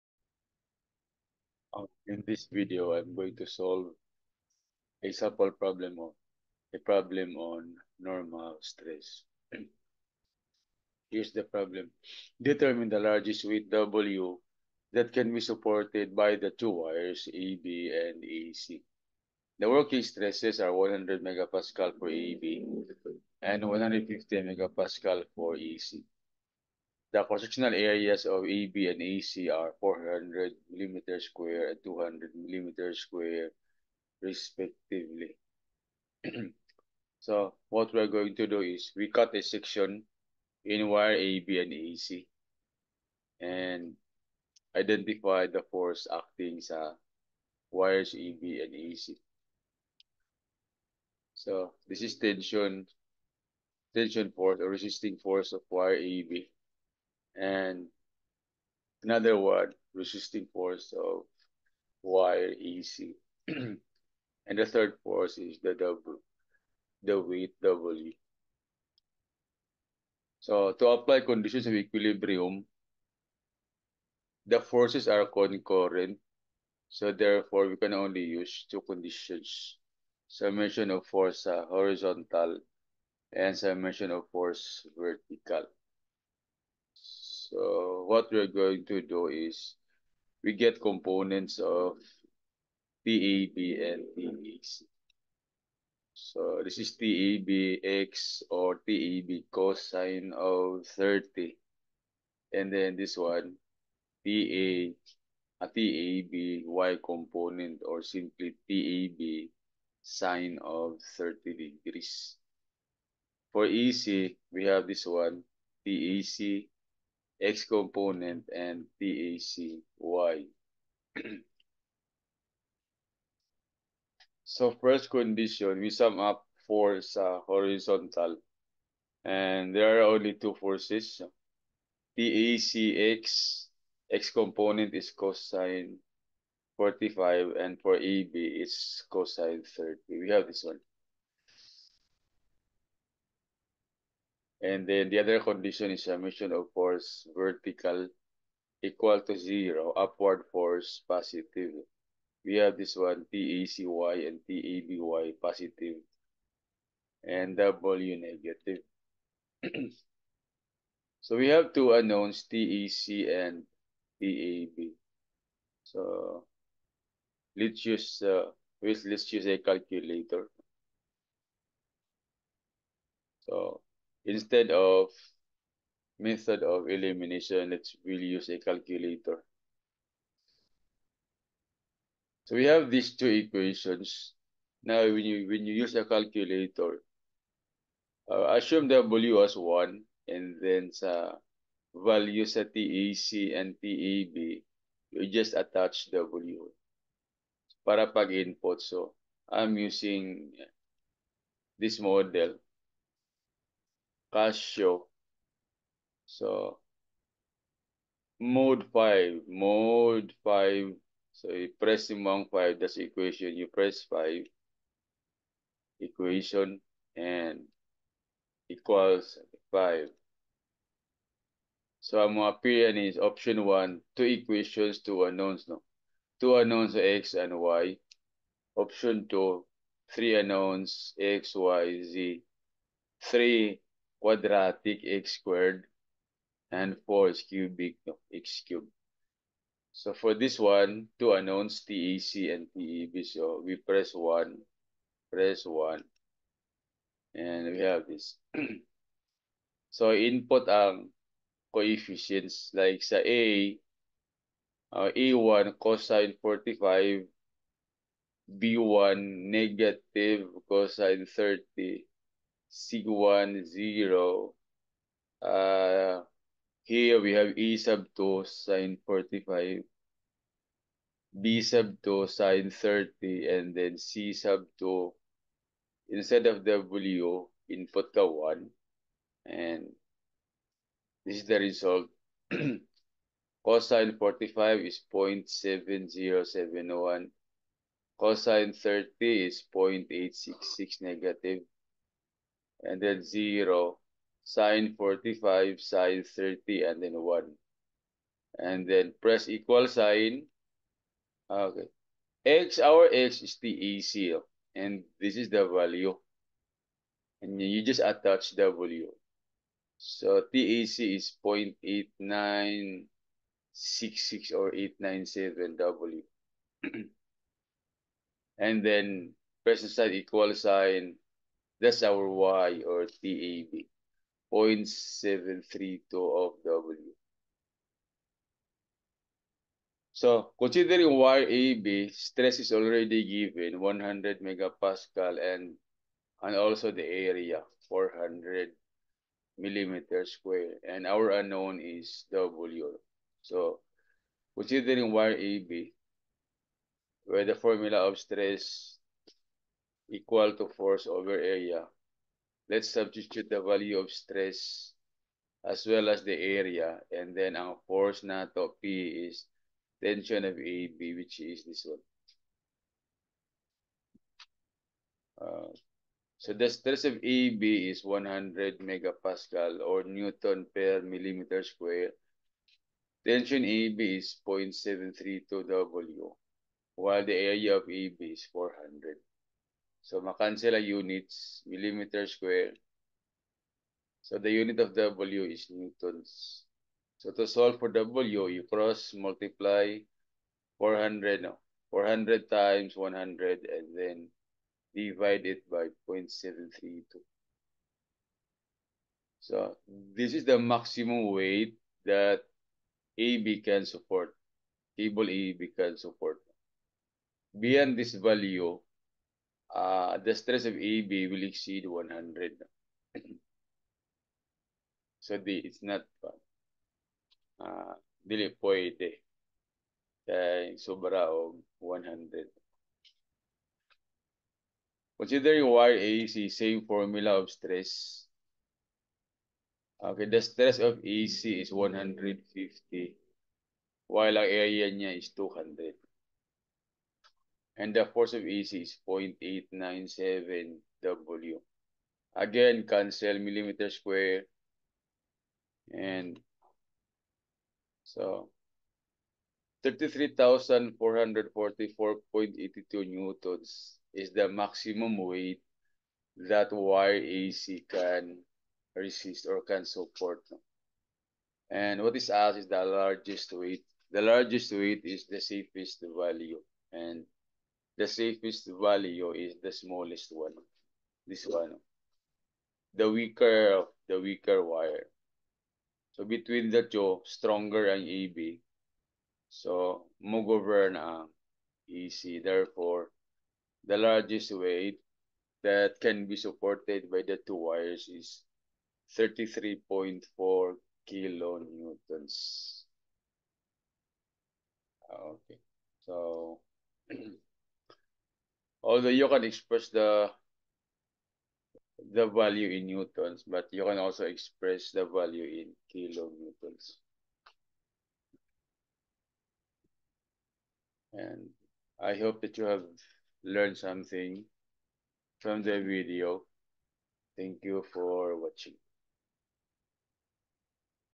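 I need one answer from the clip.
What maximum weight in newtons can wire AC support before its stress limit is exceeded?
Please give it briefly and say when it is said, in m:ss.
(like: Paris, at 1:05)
33,444.82 newtons, at 7:29.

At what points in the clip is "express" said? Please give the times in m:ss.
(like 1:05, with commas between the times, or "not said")
8:19, 8:24.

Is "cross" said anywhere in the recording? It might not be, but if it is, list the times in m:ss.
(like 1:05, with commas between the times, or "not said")
0:27, 6:28.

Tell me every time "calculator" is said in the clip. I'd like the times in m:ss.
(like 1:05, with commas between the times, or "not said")
2:49, 2:58, 3:06.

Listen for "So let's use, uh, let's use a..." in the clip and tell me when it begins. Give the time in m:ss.
2:45.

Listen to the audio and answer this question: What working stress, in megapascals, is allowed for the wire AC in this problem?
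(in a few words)
150 megapascal.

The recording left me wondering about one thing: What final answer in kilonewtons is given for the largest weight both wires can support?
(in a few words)
33.4 kilonewtons.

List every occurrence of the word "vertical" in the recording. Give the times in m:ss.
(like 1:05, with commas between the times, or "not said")
1:24, 2:27.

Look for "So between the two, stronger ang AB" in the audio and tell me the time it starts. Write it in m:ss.
7:56.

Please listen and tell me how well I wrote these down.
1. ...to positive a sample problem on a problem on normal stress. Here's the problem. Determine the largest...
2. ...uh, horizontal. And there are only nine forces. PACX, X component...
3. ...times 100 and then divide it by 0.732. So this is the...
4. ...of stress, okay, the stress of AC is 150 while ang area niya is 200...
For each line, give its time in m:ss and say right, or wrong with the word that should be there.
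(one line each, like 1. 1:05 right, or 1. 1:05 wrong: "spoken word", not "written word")
1. 0:03 wrong: "solve", not "positive"
2. 2:07 wrong: "two", not "nine"
3. 6:32 right
4. 7:07 right.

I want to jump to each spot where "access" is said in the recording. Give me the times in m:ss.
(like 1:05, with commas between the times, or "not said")
not said.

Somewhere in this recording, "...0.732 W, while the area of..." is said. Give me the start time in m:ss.
6:14.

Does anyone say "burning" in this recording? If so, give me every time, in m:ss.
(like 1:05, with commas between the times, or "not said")
not said.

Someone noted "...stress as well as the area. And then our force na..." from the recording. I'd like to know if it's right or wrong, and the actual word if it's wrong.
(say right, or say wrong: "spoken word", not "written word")
right.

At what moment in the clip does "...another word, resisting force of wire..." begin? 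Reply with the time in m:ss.
0:59.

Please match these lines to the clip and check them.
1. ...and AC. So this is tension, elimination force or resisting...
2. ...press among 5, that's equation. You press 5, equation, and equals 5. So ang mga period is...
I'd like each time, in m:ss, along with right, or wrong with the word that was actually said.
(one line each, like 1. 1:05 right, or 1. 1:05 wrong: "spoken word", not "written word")
1. 0:48 wrong: "tension", not "elimination"
2. 3:31 right.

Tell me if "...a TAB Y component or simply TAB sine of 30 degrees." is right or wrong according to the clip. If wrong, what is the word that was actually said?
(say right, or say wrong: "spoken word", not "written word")
right.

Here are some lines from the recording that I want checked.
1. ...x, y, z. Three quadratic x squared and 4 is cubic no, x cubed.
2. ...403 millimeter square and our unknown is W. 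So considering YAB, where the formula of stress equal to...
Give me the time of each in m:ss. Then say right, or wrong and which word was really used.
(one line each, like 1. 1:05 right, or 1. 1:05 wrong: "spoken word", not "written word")
1. 3:51 right
2. 5:37 wrong: "400", not "403".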